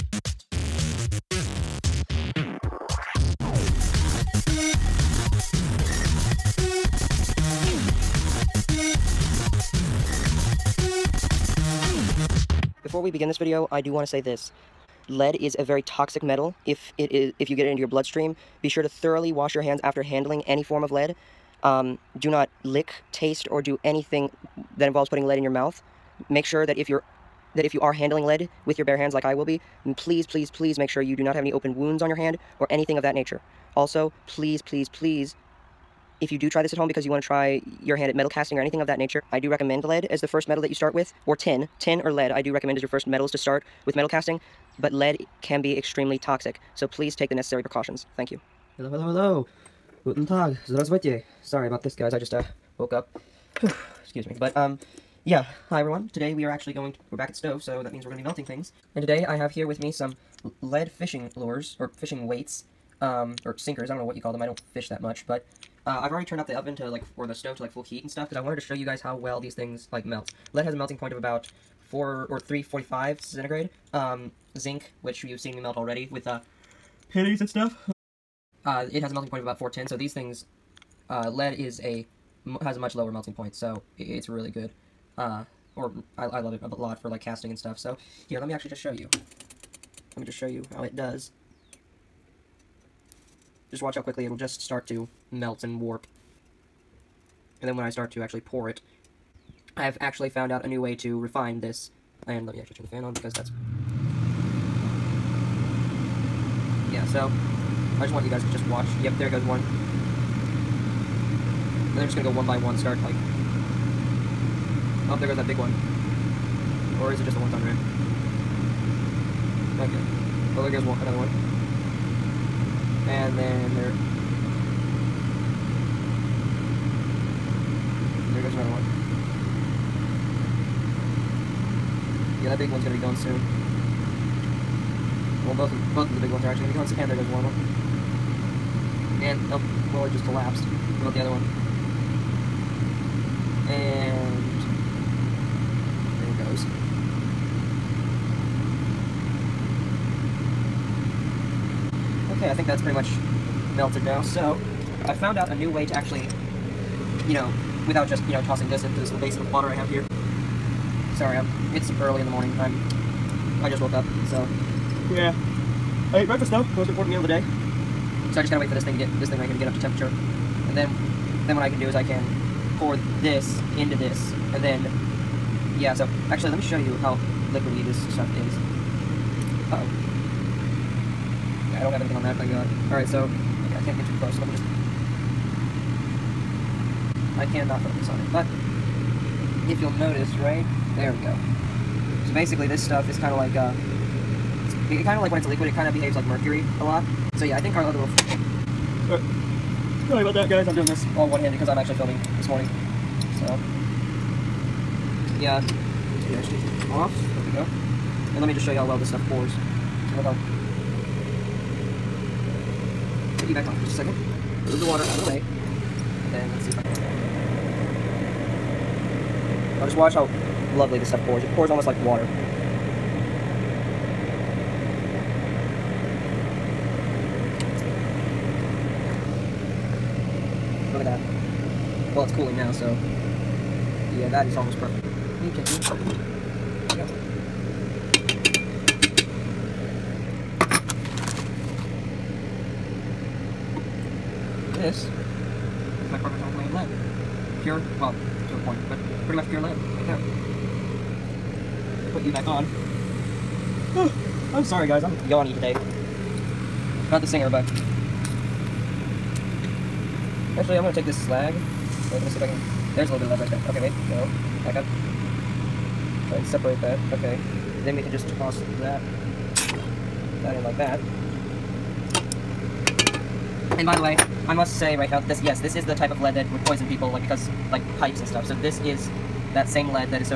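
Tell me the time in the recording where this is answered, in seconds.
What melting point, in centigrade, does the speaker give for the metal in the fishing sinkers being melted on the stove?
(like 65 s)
72 s.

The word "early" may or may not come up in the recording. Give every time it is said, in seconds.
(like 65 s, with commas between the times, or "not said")
162 s.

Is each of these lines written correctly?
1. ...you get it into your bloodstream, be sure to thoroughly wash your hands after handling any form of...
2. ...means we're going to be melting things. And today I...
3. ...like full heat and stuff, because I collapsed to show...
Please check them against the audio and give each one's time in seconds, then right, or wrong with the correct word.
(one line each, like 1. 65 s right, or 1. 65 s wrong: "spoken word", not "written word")
1. 17 s right
2. 57 s right
3. 67 s wrong: "wanted", not "collapsed".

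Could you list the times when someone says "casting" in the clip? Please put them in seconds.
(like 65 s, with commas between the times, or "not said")
38 s, 44 s, 87 s.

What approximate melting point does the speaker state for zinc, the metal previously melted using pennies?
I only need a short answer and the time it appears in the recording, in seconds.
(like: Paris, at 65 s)
410, at 79 s.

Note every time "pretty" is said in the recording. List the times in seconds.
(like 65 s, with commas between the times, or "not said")
152 s, 249 s.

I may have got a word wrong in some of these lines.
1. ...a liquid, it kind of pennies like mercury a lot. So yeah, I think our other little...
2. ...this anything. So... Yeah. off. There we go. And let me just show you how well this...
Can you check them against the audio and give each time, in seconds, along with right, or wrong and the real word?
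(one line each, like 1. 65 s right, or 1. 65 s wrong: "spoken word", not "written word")
1. 195 s wrong: "behaves", not "pennies"
2. 202 s wrong: "morning", not "anything".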